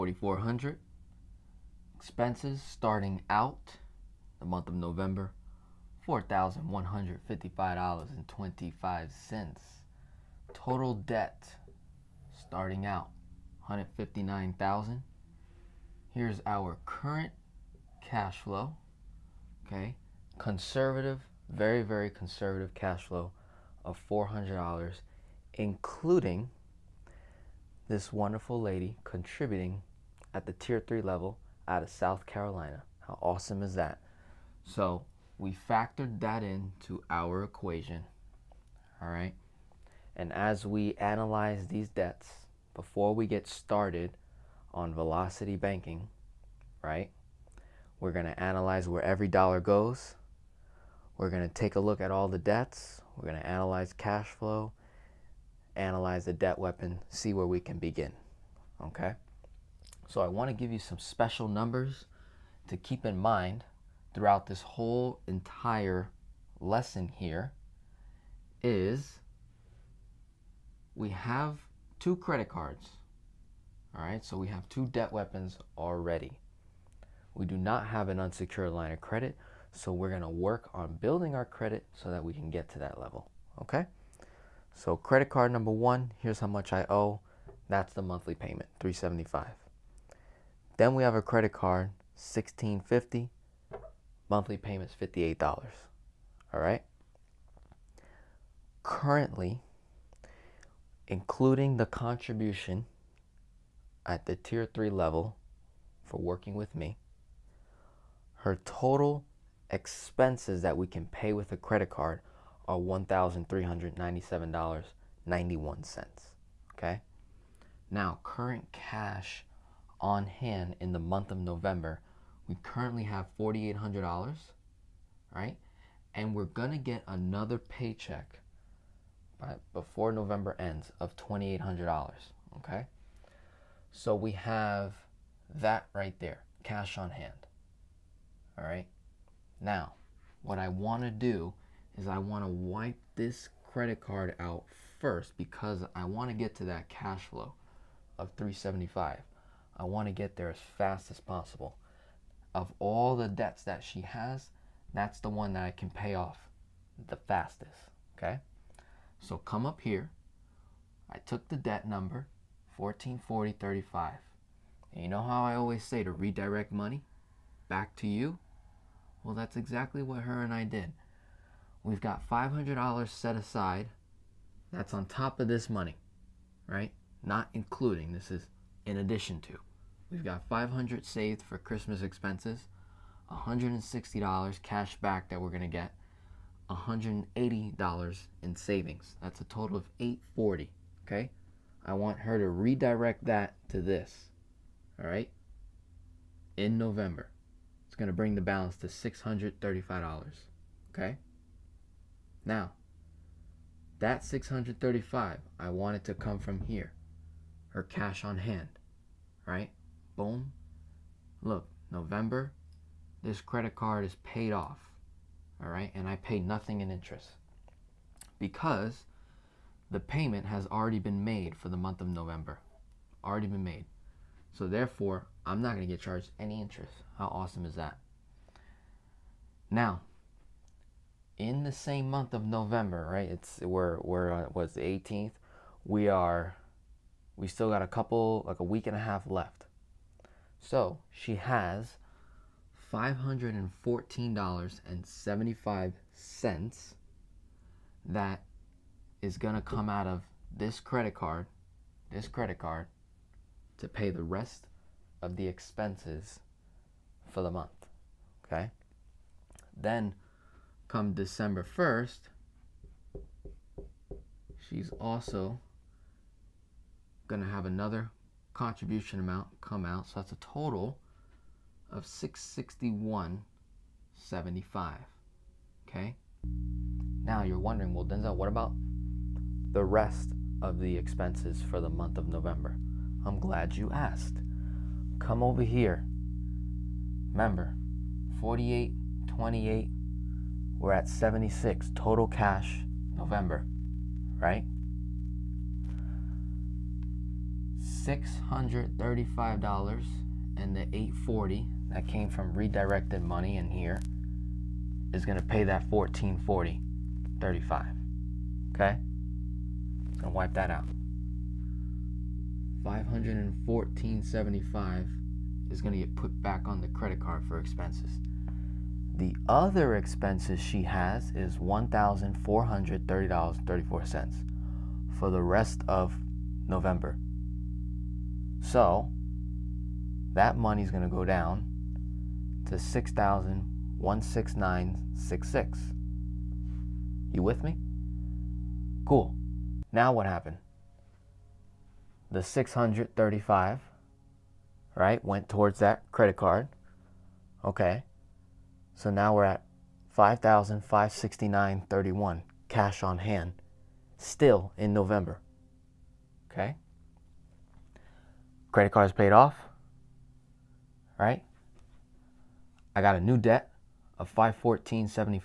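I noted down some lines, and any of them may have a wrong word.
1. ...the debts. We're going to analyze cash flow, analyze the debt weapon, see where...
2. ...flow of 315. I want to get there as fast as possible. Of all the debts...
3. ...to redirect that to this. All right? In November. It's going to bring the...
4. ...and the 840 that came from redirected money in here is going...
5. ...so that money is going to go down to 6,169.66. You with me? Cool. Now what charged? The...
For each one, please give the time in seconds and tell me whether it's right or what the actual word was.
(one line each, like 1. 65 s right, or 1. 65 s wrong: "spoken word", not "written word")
1. 52 s right
2. 147 s wrong: "375", not "315"
3. 192 s right
4. 300 s right
5. 328 s wrong: "happened", not "charged".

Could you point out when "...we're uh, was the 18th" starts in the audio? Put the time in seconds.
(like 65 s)
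234 s.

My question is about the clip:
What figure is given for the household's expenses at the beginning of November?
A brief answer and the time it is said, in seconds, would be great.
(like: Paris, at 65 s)
$4,155.25, at 6 s.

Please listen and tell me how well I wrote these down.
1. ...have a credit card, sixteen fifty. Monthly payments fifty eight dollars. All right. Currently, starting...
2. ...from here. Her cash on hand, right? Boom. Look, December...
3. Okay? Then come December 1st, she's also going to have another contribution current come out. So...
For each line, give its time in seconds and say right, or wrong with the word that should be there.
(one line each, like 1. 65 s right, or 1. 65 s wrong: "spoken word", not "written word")
1. 91 s wrong: "including", not "starting"
2. 206 s wrong: "November", not "December"
3. 258 s wrong: "amount", not "current".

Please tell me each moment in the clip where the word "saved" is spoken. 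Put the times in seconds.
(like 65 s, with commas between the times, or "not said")
181 s.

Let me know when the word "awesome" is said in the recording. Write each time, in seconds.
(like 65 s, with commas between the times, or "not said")
33 s, 227 s.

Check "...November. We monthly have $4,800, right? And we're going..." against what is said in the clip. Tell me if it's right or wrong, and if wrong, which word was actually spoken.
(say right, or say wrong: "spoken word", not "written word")
wrong: "currently", not "monthly".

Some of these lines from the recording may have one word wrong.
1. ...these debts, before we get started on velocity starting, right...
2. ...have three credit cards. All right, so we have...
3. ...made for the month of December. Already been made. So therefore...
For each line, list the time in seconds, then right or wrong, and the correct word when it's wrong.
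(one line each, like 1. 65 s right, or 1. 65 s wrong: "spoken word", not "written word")
1. 41 s wrong: "banking", not "starting"
2. 71 s wrong: "two", not "three"
3. 221 s wrong: "November", not "December".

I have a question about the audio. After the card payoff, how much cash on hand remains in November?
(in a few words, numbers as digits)
$5,569.31.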